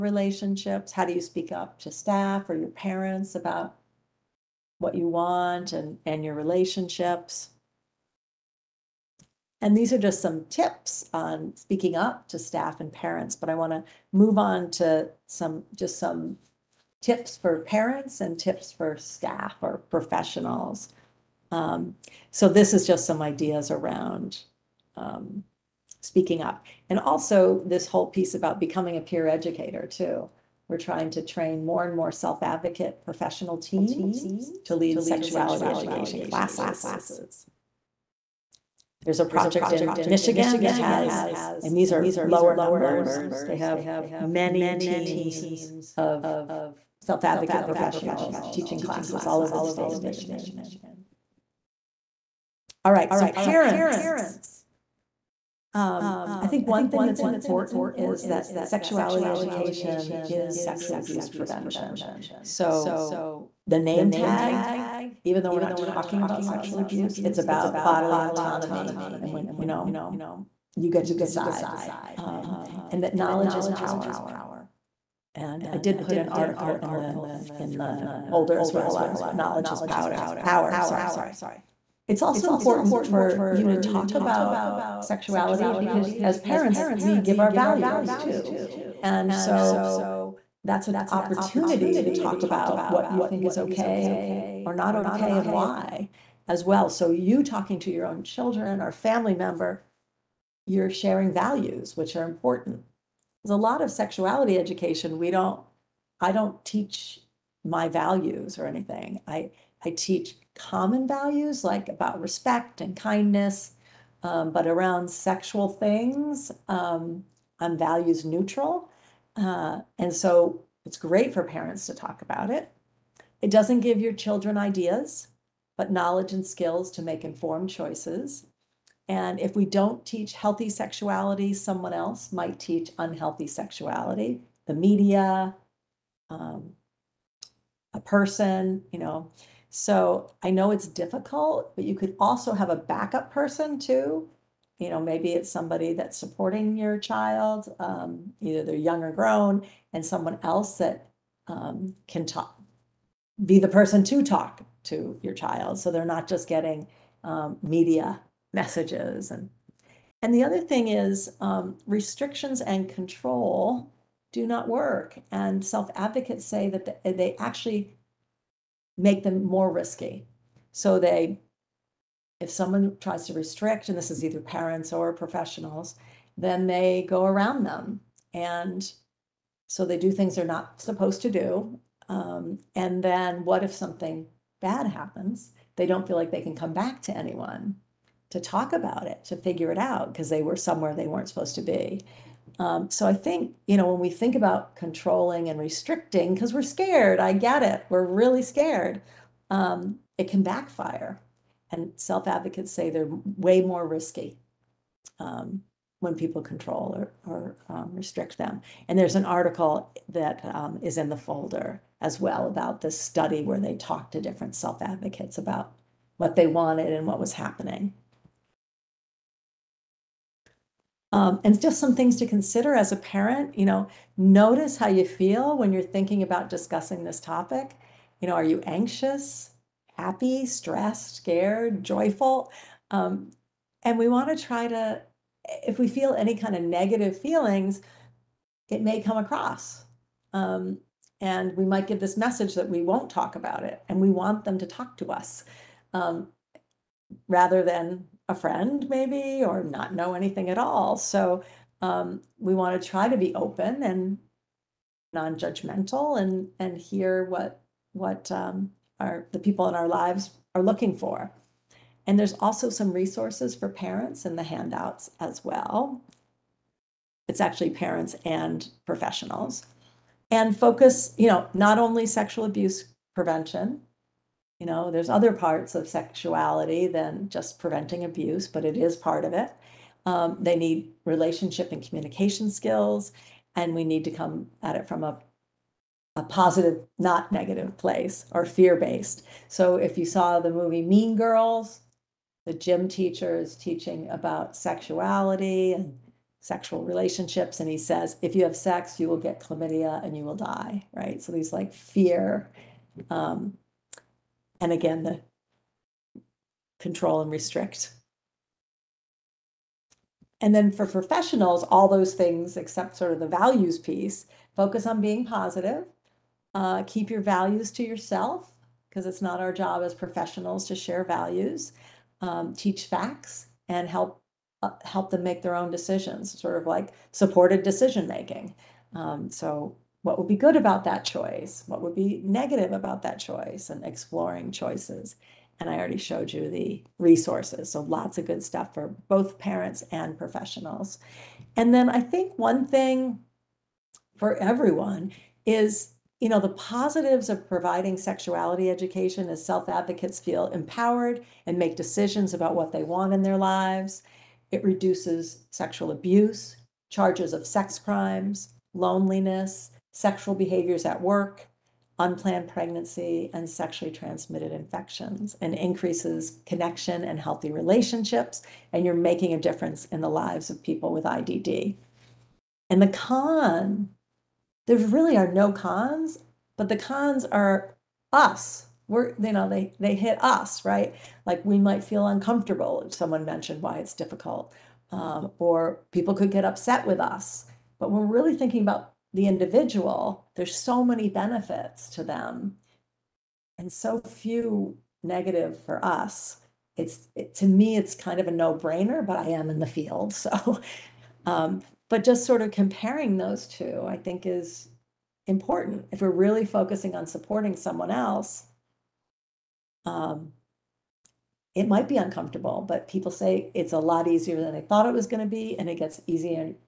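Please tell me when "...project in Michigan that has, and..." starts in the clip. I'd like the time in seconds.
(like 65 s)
39 s.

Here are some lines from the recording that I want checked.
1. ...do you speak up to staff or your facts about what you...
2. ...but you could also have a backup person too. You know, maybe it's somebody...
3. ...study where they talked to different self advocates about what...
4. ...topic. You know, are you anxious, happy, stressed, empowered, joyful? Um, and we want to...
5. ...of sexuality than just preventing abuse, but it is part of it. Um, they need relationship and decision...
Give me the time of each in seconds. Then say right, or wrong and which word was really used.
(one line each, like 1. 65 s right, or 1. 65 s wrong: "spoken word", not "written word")
1. 1 s wrong: "parents", not "facts"
2. 141 s right
3. 212 s right
4. 227 s wrong: "scared", not "empowered"
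5. 275 s wrong: "communication", not "decision".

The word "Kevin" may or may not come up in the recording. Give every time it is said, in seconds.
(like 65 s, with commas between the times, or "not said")
not said.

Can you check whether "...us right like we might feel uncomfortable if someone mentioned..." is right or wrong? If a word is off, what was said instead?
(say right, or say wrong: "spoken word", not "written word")
right.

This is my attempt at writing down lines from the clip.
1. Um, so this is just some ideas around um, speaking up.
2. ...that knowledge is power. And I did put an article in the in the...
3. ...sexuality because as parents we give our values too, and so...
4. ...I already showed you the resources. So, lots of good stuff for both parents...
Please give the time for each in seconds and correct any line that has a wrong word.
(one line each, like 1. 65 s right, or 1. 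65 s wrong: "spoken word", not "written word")
1. 21 s right
2. 73 s right
3. 84 s right
4. 335 s right.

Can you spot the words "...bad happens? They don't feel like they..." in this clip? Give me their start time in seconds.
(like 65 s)
184 s.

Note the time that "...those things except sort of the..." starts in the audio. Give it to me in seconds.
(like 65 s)
311 s.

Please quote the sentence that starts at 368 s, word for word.
And you're making a difference in the lives of people with IDD.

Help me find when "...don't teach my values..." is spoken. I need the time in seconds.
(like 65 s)
106 s.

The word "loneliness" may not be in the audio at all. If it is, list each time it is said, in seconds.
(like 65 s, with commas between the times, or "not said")
358 s.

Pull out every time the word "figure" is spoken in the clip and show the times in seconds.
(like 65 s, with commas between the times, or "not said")
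189 s.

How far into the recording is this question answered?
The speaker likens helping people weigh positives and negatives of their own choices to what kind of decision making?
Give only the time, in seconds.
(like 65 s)
327 s.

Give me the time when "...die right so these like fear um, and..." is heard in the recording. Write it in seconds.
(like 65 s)
300 s.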